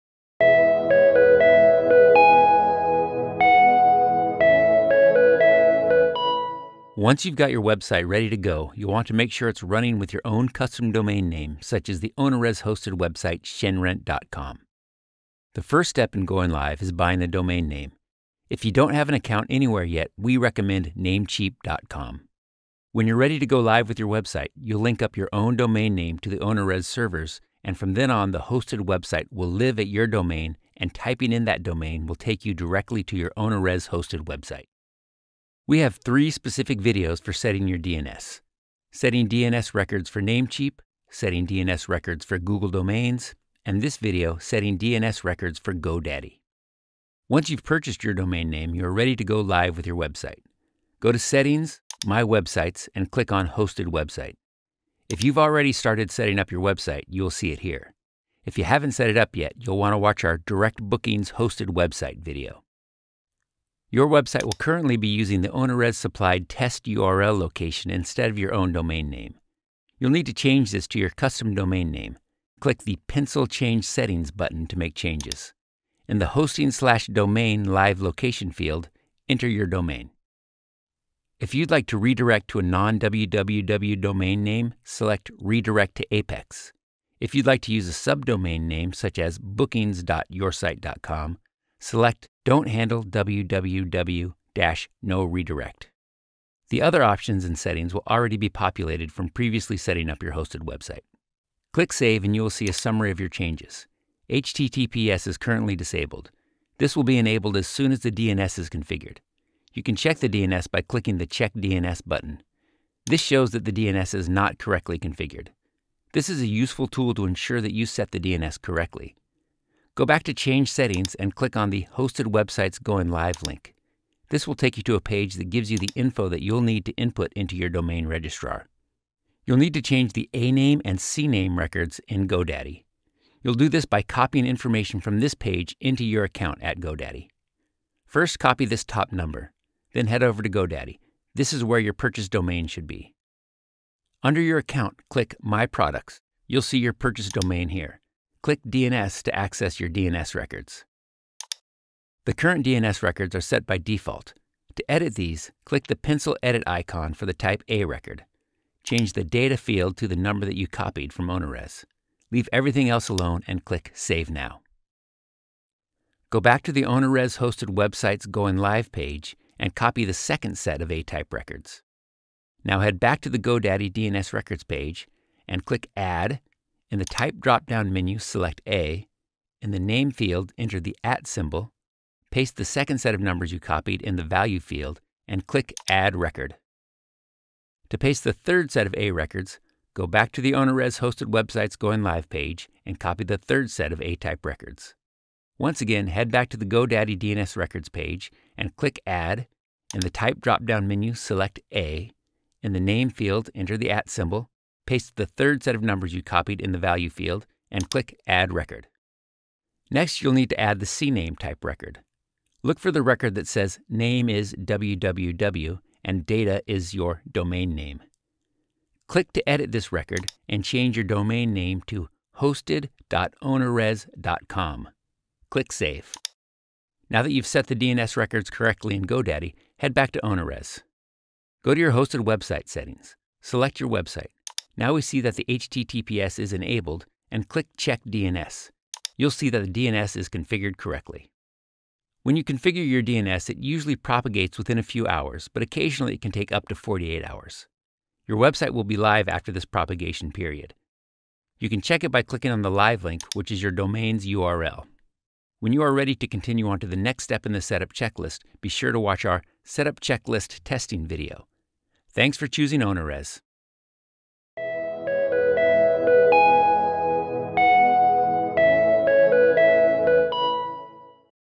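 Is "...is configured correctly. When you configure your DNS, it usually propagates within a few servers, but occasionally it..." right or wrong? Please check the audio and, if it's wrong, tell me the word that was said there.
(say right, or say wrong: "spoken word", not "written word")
wrong: "hours", not "servers".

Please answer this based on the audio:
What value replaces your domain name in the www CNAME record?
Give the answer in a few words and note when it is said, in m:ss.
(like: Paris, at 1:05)
hosted.ownerrez.com, at 3:42.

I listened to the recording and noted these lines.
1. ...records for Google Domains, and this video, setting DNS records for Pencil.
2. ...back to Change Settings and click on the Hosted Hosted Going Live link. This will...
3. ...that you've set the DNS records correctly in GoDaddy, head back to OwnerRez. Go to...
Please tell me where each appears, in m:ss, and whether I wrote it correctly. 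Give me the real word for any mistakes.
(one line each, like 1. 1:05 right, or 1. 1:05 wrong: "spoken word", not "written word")
1. 0:41 wrong: "GoDaddy", not "Pencil"
2. 2:00 wrong: "Websites", not "Hosted"
3. 3:47 right.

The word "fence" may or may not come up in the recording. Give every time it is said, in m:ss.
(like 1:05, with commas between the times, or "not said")
not said.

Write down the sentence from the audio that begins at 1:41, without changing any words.
Click Save and you will see a summary of your changes.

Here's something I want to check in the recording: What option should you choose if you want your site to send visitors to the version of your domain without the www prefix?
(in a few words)
Redirect to Apex.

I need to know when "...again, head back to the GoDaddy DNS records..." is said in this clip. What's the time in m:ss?
3:15.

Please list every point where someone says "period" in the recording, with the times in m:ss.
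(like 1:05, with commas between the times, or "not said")
4:10.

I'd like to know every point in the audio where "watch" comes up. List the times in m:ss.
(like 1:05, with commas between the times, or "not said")
0:59, 4:18.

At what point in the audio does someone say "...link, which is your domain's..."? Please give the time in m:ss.
4:13.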